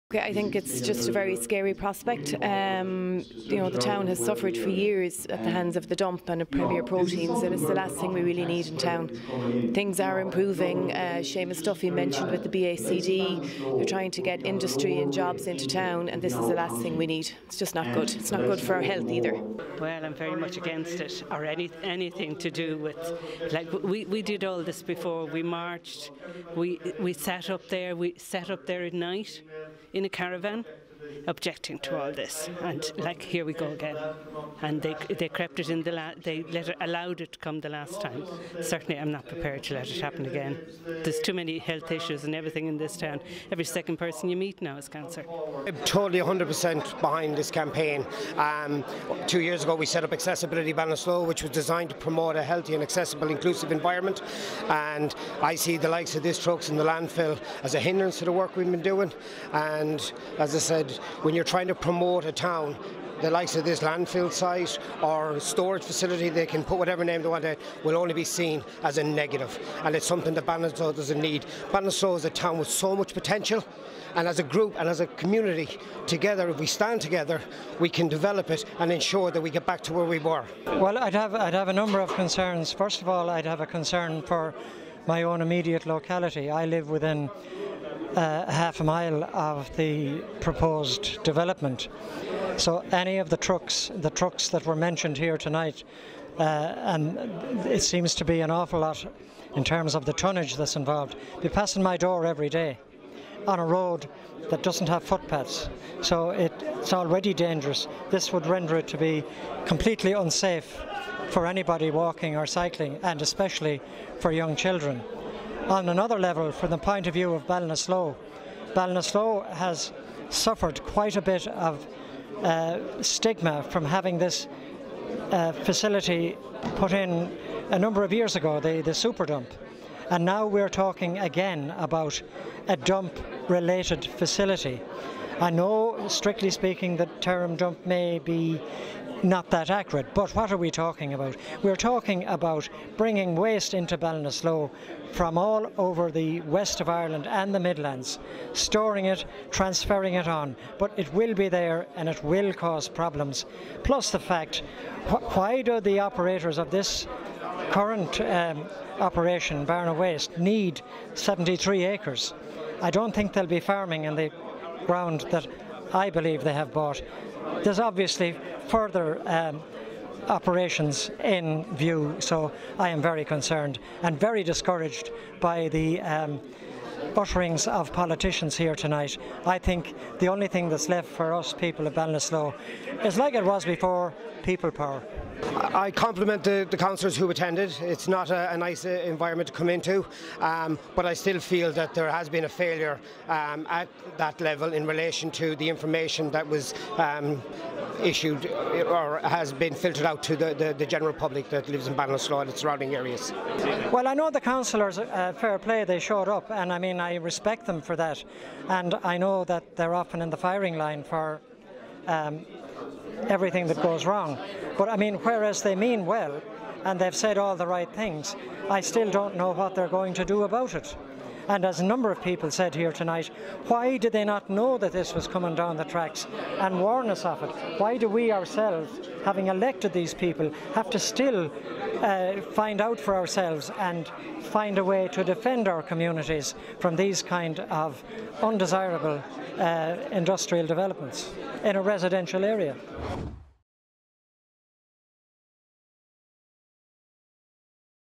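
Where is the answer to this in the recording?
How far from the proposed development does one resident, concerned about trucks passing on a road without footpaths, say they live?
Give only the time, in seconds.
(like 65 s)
88 s.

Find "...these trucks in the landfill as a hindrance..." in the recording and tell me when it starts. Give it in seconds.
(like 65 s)
56 s.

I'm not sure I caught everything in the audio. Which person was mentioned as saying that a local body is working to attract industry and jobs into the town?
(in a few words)
Seamus Duffy.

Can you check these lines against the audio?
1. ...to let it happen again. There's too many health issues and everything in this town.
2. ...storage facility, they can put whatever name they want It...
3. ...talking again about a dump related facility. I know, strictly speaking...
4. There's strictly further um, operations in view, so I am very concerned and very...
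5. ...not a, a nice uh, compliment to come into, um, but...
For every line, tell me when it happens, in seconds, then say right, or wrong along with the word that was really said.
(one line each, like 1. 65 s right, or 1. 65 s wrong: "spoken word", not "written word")
1. 39 s right
2. 65 s right
3. 130 s right
4. 167 s wrong: "obviously", not "strictly"
5. 188 s wrong: "environment", not "compliment".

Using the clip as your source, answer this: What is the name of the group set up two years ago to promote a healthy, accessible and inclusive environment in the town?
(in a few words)
Accessibility Ballinasloe.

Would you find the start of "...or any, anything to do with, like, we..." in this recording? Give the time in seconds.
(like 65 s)
21 s.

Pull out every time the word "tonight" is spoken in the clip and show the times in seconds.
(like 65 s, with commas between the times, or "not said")
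95 s, 178 s, 222 s.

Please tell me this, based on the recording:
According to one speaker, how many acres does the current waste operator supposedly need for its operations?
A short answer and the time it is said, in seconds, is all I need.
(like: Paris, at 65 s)
73, at 161 s.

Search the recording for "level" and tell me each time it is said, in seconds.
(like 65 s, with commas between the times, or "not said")
116 s, 194 s.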